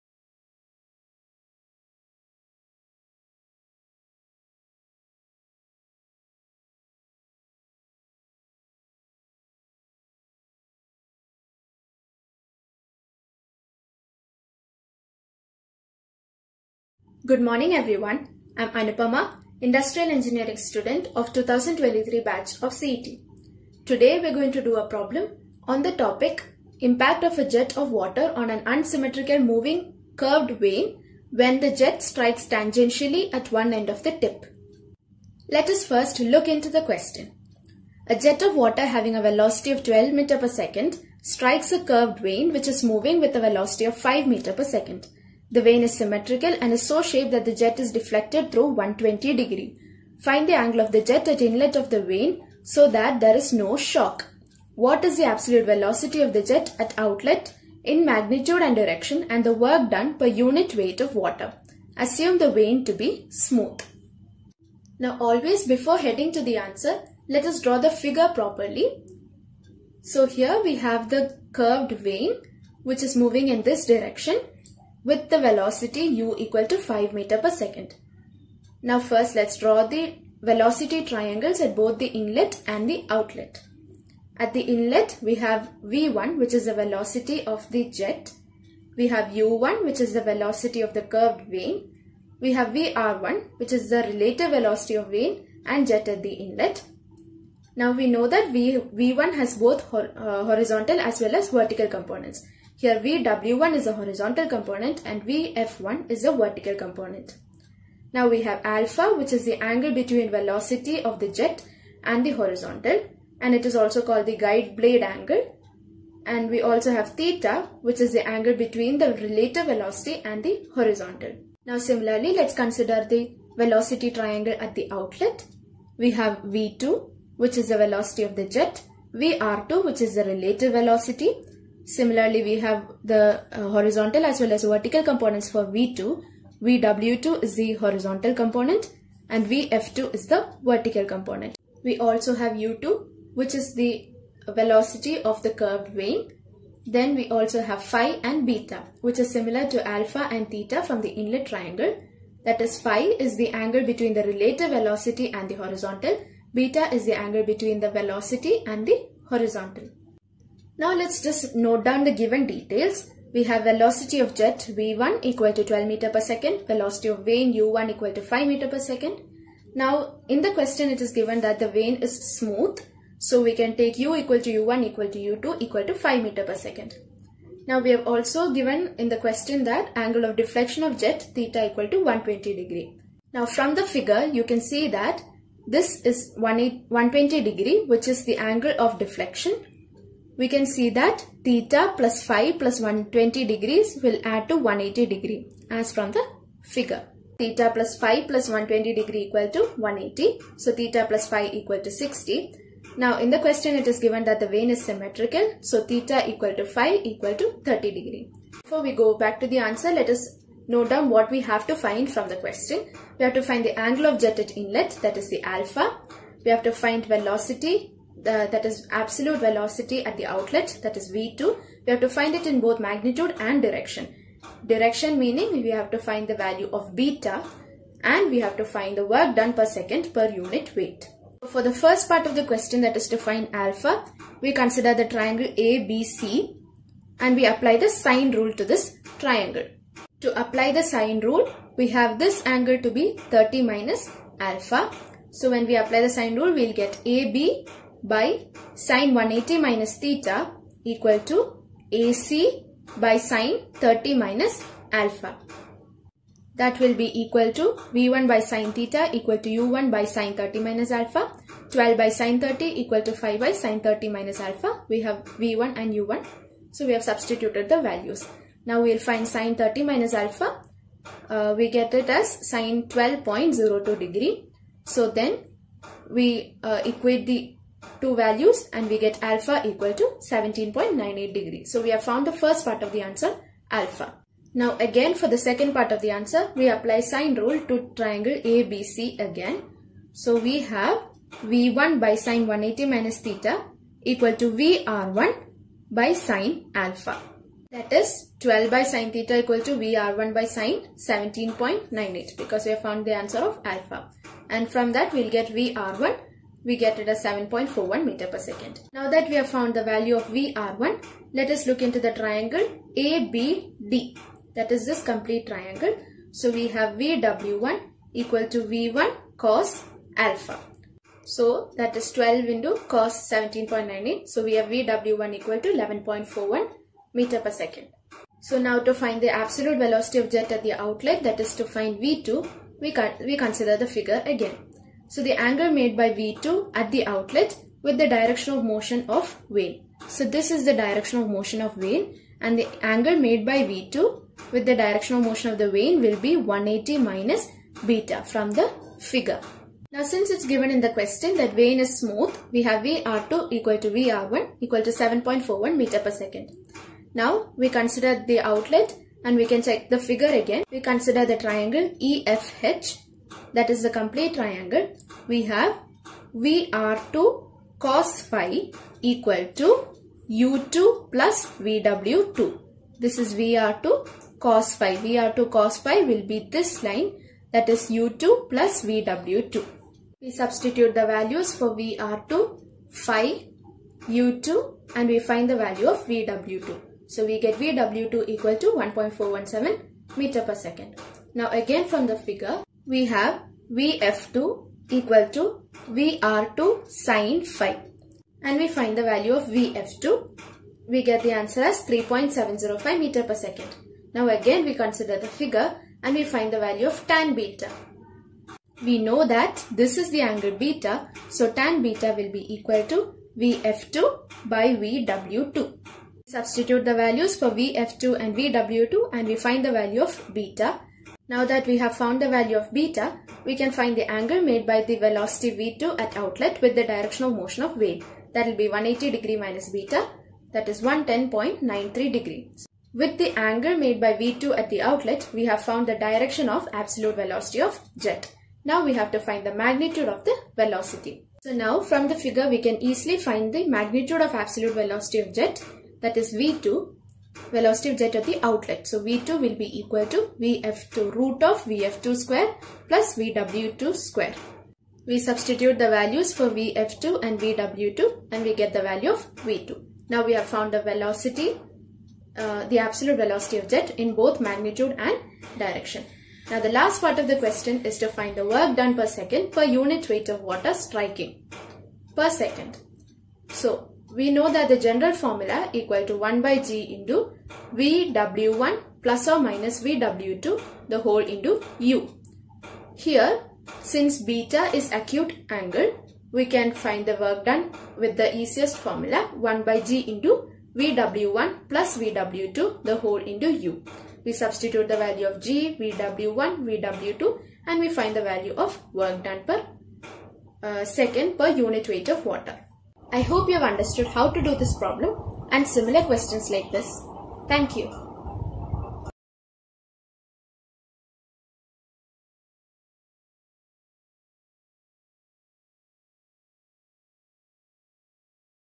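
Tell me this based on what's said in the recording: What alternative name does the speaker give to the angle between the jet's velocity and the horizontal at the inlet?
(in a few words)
guide blade angle.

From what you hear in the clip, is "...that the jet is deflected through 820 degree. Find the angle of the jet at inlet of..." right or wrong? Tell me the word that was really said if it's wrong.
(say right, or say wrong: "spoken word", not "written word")
wrong: "120", not "820".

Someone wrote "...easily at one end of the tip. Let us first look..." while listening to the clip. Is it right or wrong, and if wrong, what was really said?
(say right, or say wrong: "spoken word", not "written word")
wrong: "tangentially", not "easily".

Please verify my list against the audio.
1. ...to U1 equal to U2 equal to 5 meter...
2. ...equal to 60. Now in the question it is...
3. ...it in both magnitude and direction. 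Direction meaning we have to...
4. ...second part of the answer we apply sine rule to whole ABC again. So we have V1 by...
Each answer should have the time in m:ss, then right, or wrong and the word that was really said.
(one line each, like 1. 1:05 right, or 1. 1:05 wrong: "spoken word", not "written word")
1. 2:54 right
2. 3:21 right
3. 3:42 right
4. 4:45 wrong: "triangle", not "whole".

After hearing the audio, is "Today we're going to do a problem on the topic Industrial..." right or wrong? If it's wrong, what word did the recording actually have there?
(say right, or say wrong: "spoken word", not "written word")
wrong: "Impact", not "Industrial".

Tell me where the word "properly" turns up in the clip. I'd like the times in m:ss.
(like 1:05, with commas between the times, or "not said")
1:08.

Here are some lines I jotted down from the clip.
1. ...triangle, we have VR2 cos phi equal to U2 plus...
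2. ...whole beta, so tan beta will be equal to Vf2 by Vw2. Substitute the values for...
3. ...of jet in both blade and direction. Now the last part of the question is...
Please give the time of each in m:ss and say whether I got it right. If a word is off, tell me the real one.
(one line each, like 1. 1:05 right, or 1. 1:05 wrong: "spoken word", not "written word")
1. 6:04 right
2. 6:50 wrong: "angle", not "whole"
3. 7:43 wrong: "magnitude", not "blade".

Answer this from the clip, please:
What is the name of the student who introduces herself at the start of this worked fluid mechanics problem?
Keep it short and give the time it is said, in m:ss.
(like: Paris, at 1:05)
Anupama, at 0:18.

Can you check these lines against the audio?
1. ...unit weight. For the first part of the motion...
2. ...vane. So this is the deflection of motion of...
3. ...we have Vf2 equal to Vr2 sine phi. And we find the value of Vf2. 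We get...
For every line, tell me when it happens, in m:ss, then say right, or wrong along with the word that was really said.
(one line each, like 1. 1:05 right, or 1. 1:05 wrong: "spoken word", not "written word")
1. 3:50 wrong: "question", not "motion"
2. 5:39 wrong: "direction", not "deflection"
3. 6:32 right.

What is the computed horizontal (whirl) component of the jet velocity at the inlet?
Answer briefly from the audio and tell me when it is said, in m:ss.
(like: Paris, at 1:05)
11.41 m/s, at 5:25.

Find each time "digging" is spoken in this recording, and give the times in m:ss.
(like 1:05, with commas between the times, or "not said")
not said.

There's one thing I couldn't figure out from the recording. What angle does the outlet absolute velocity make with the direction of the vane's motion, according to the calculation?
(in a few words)
110.93 degrees.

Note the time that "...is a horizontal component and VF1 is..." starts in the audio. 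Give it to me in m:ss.
1:43.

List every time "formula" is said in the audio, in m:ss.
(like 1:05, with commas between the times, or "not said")
7:55, 8:08.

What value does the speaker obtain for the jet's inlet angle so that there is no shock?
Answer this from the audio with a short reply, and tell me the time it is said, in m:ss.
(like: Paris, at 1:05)
17.98 degrees, at 4:40.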